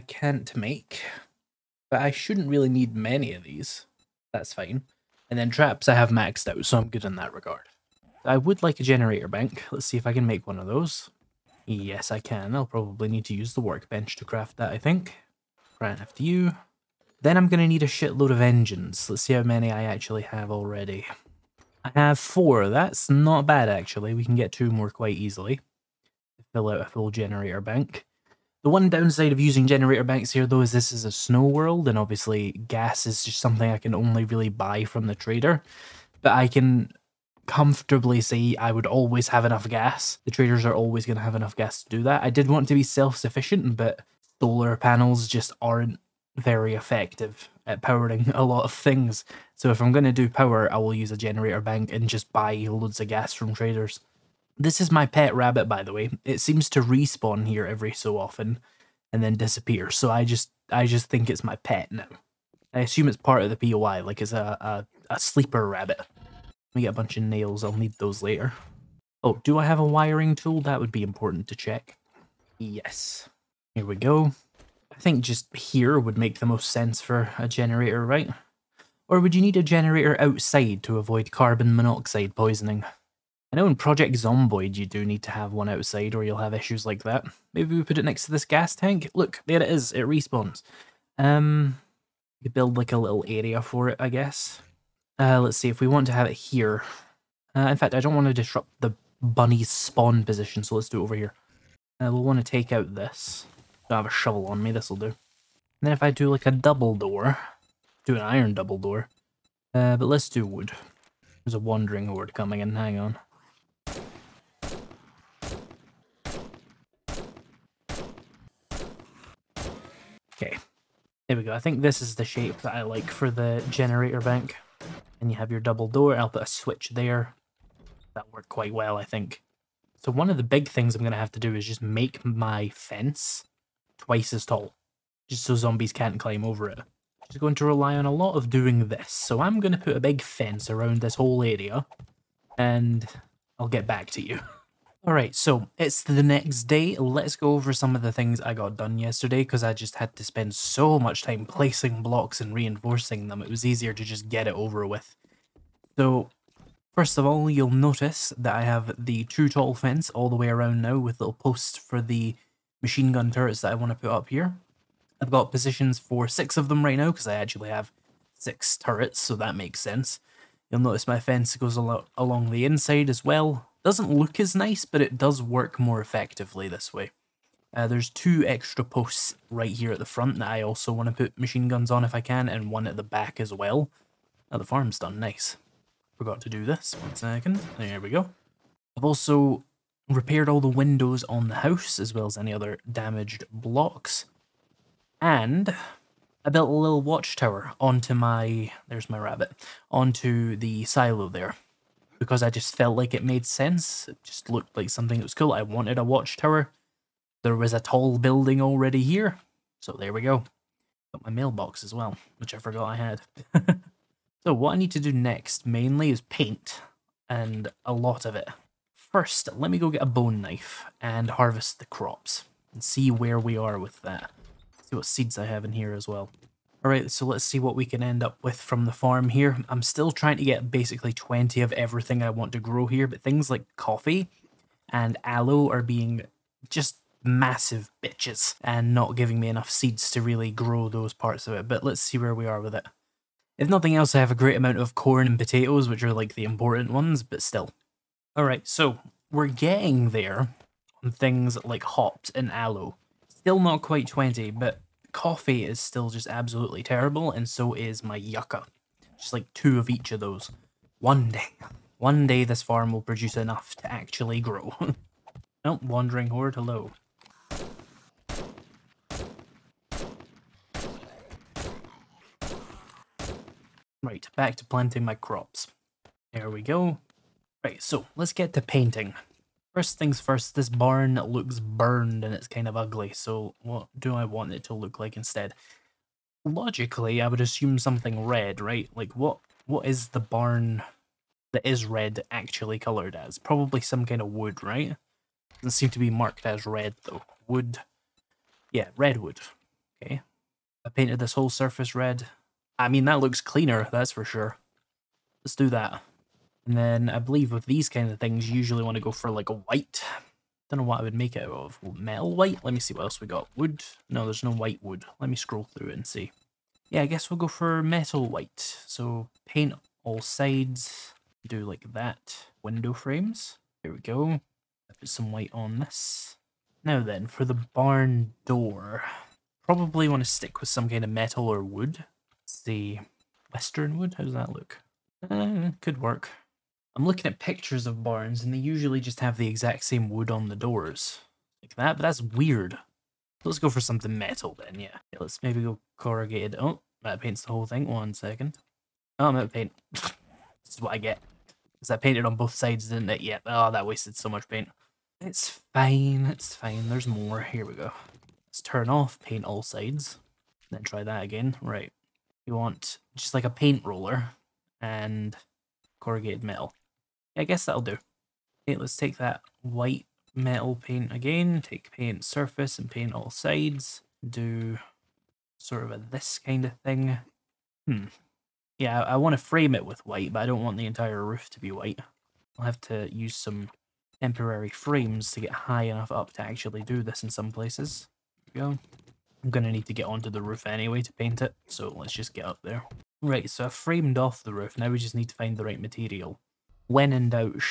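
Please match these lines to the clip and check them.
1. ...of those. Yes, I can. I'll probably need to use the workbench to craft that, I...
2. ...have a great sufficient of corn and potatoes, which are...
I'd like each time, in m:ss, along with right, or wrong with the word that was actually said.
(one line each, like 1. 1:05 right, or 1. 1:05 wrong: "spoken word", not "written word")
1. 0:10 right
2. 4:04 wrong: "amount", not "sufficient".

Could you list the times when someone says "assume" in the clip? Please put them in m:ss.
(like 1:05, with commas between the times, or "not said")
1:02, 4:47.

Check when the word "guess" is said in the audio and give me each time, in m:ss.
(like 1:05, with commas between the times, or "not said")
1:34, 5:17, 6:07.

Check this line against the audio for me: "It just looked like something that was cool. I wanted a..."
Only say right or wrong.
right.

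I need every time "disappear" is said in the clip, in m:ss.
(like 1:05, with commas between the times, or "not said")
0:59.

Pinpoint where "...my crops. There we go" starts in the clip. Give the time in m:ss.
4:35.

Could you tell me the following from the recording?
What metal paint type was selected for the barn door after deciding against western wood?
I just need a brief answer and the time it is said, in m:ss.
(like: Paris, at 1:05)
Corrugated metal, at 6:06.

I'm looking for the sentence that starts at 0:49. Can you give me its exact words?
So if I'm going to do power, I will use a generator bank and just buy loads of gas from traders.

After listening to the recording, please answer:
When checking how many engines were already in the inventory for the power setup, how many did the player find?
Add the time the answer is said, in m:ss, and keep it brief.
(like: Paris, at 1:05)
4, at 0:21.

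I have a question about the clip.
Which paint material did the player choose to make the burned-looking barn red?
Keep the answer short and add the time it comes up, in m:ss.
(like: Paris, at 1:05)
Redwood, at 4:58.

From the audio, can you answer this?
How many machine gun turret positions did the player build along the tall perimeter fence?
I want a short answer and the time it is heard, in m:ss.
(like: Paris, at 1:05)
6, at 2:46.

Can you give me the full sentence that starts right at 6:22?
I'll have to use some temporary frames to get high enough up to actually do this in some places.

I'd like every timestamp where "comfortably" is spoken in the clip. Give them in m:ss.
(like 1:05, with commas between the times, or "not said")
0:37.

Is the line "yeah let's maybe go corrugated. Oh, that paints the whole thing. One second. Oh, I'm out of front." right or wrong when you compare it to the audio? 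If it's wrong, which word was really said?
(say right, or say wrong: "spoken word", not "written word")
wrong: "paint", not "front".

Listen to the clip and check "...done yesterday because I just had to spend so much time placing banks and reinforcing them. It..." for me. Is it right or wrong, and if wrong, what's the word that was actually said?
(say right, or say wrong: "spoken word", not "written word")
wrong: "blocks", not "banks".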